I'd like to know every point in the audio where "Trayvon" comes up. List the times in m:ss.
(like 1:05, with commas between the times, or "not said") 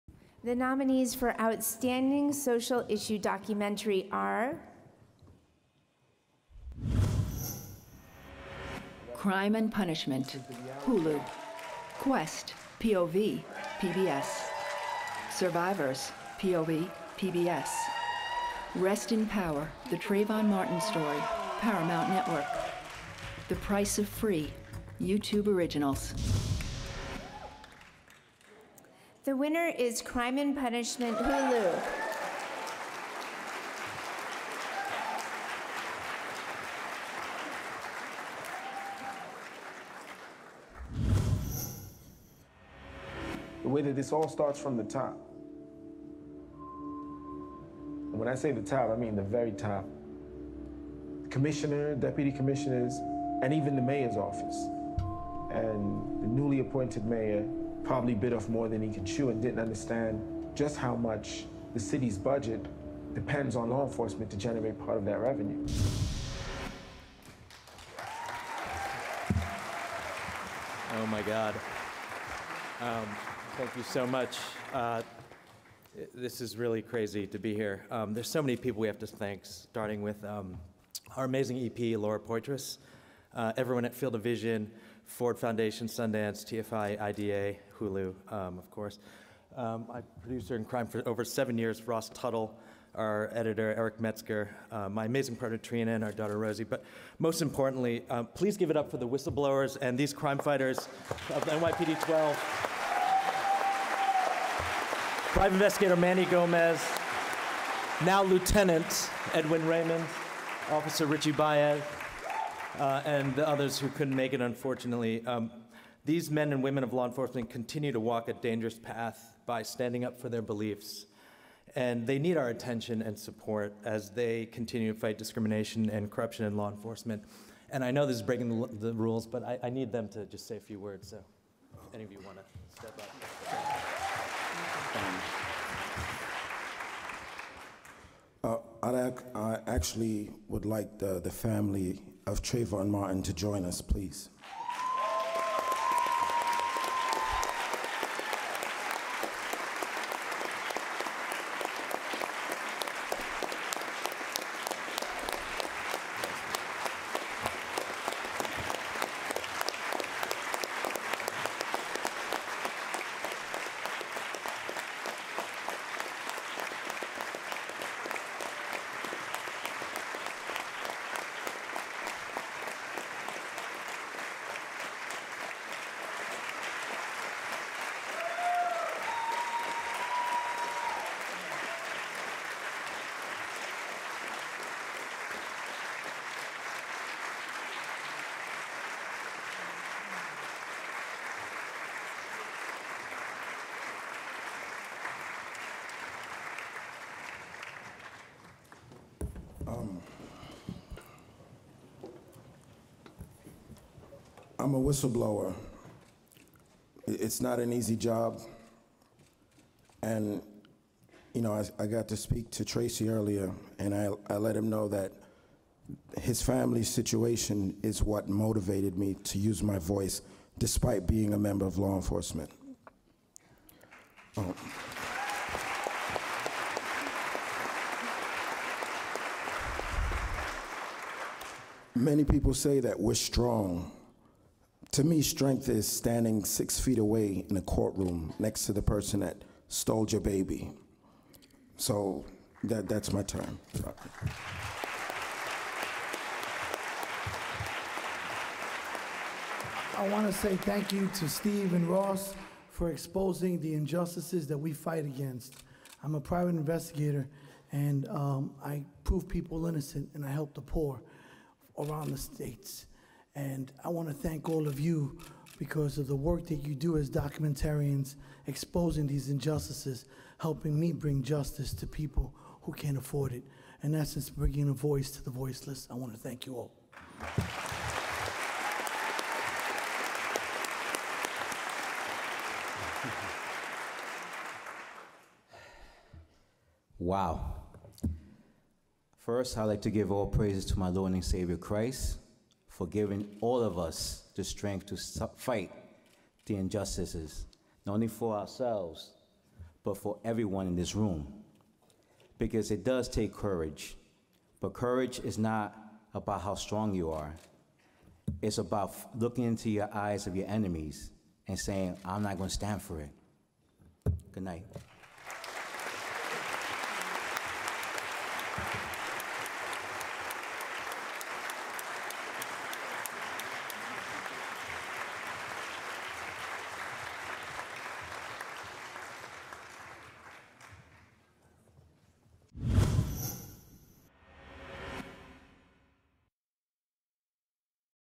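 0:19, 2:22.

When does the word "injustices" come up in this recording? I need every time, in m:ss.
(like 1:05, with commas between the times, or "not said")
4:13, 4:29, 4:56.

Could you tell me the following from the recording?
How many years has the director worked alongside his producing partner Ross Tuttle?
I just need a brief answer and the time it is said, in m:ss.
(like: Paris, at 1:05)
7, at 1:31.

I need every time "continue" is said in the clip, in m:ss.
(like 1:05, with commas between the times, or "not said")
1:57, 2:04.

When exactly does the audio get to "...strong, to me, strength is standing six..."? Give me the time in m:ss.
3:53.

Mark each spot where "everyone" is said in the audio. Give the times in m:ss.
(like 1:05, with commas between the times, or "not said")
1:23, 5:00.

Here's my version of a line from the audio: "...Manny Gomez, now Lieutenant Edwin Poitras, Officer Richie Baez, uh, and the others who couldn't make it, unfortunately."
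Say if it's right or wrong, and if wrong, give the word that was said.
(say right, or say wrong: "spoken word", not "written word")
wrong: "Raymond", not "Poitras".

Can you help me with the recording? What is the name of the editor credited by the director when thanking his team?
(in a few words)
Eric Metzger.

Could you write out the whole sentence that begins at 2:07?
And I know this is breaking the, the rules, but I, I, need them to just say a few words.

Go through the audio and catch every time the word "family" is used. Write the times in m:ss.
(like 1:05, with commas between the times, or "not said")
2:21, 3:36.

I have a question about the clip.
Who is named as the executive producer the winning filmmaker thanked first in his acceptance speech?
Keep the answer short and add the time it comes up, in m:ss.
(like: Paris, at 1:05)
Laura Poitras, at 1:21.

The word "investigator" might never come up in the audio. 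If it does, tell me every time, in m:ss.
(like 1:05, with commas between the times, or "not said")
1:45, 4:16.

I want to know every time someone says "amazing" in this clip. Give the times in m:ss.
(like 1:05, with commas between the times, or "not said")
1:21, 1:35.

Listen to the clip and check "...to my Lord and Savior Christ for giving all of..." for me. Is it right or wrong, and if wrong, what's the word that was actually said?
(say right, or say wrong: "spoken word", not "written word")
right.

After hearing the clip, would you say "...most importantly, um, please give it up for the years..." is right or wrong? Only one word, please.
wrong.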